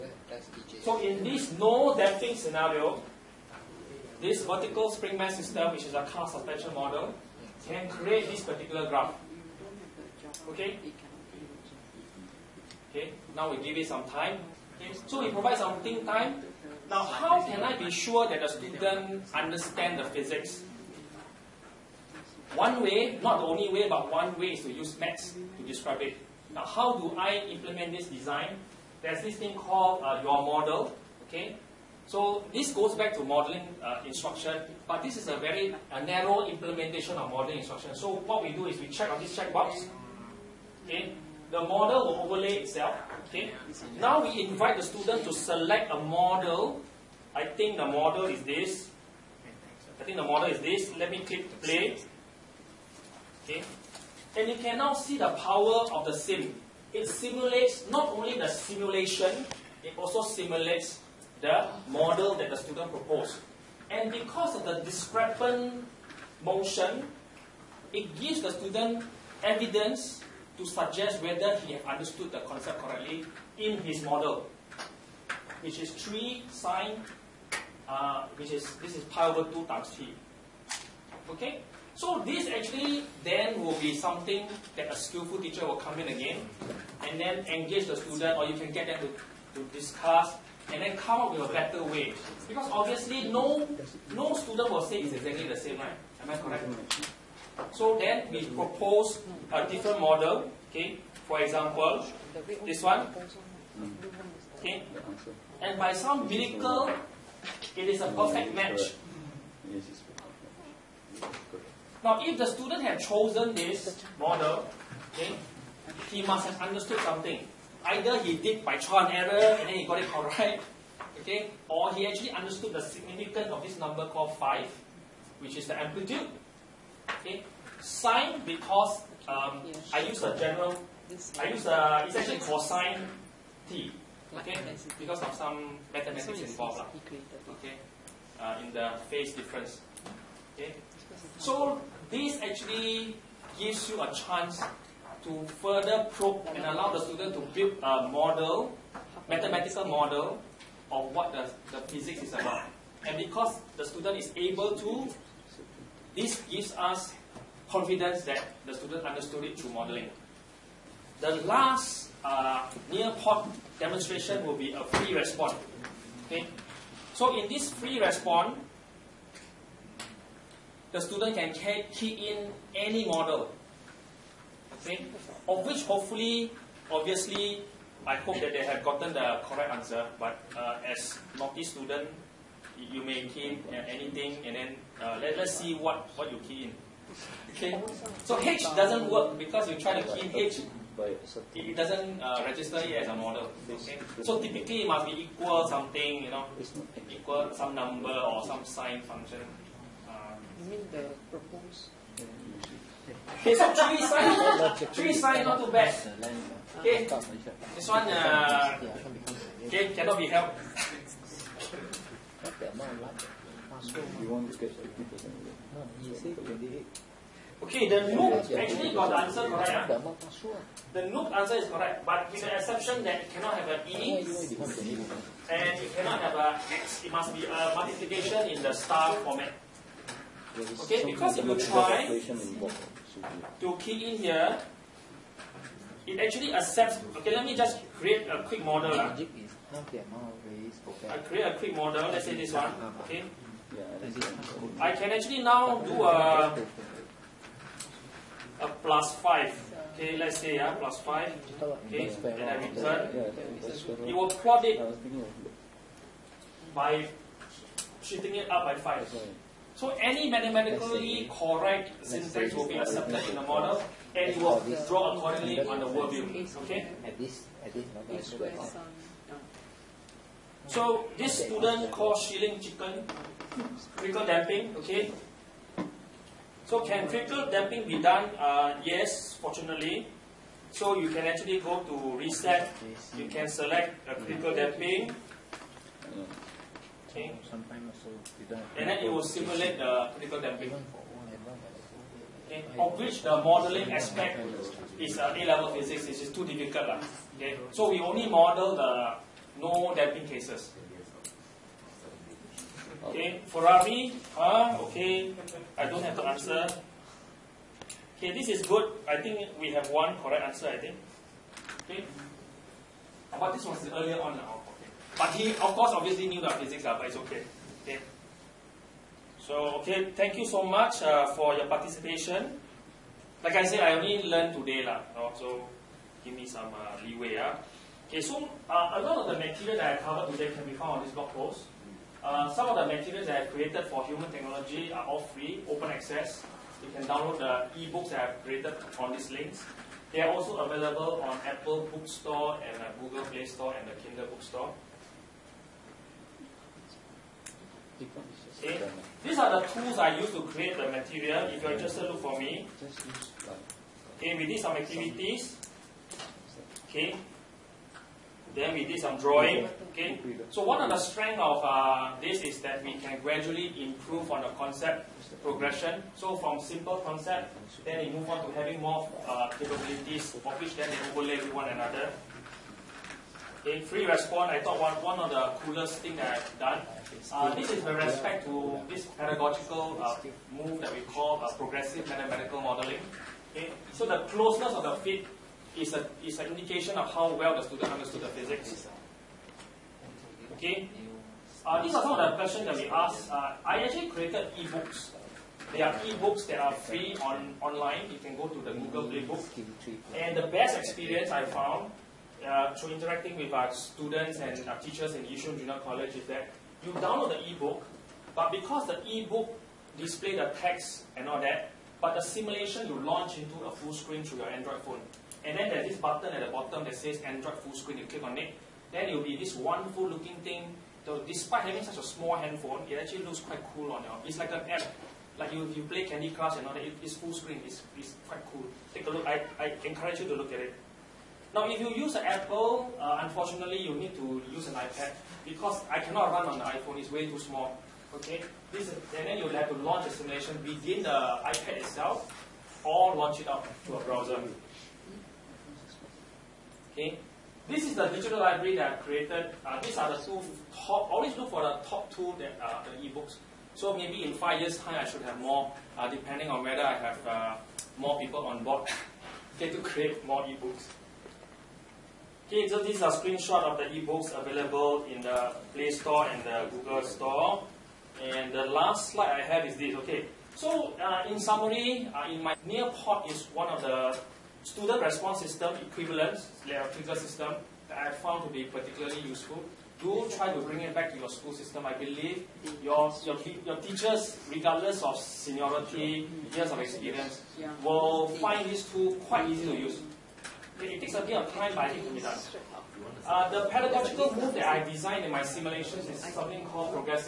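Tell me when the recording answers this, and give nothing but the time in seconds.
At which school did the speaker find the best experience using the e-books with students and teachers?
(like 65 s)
405 s.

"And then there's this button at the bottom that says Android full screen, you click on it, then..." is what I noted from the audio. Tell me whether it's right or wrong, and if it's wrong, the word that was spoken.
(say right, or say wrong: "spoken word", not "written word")
right.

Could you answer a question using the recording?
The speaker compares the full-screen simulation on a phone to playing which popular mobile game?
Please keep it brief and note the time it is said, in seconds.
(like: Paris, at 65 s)
Candy Crush, at 426 s.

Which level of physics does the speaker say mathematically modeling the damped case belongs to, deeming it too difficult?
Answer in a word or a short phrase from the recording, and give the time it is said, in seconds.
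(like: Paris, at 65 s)
A-level, at 295 s.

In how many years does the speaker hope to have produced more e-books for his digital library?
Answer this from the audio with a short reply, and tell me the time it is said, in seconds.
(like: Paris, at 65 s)
5, at 454 s.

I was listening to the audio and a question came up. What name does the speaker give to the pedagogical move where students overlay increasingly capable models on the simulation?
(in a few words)
Progressive mathematical modeling.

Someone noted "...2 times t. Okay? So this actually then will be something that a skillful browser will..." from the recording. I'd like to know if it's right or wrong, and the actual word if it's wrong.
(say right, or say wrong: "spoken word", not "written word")
wrong: "teacher", not "browser".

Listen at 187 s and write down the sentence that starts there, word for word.
Okay, so H doesn't work because you try to key in H, it doesn't uh, register it as a model.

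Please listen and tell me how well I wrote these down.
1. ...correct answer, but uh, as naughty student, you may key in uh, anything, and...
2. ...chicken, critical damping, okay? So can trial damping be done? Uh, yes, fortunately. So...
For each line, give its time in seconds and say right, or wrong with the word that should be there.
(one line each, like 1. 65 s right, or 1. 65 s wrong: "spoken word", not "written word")
1. 179 s right
2. 272 s wrong: "critical", not "trial".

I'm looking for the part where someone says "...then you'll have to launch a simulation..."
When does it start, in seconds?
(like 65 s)
439 s.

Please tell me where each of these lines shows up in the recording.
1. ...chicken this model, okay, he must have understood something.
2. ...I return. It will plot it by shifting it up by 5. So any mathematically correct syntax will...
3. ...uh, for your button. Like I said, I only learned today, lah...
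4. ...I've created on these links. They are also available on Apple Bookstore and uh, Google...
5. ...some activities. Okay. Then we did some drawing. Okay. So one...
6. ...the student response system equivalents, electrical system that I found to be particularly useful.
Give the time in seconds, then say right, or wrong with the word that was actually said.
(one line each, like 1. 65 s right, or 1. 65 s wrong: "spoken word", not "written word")
1. 112 s wrong: "chosen", not "chicken"
2. 252 s right
3. 321 s wrong: "participation", not "button"
4. 338 s right
5. 354 s right
6. 473 s right.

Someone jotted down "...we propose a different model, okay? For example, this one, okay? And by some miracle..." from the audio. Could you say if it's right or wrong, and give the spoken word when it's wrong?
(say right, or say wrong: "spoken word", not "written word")
right.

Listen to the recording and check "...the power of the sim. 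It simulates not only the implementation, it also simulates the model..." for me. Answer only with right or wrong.
wrong.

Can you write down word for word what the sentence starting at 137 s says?
Okay, uh, in the phase difference.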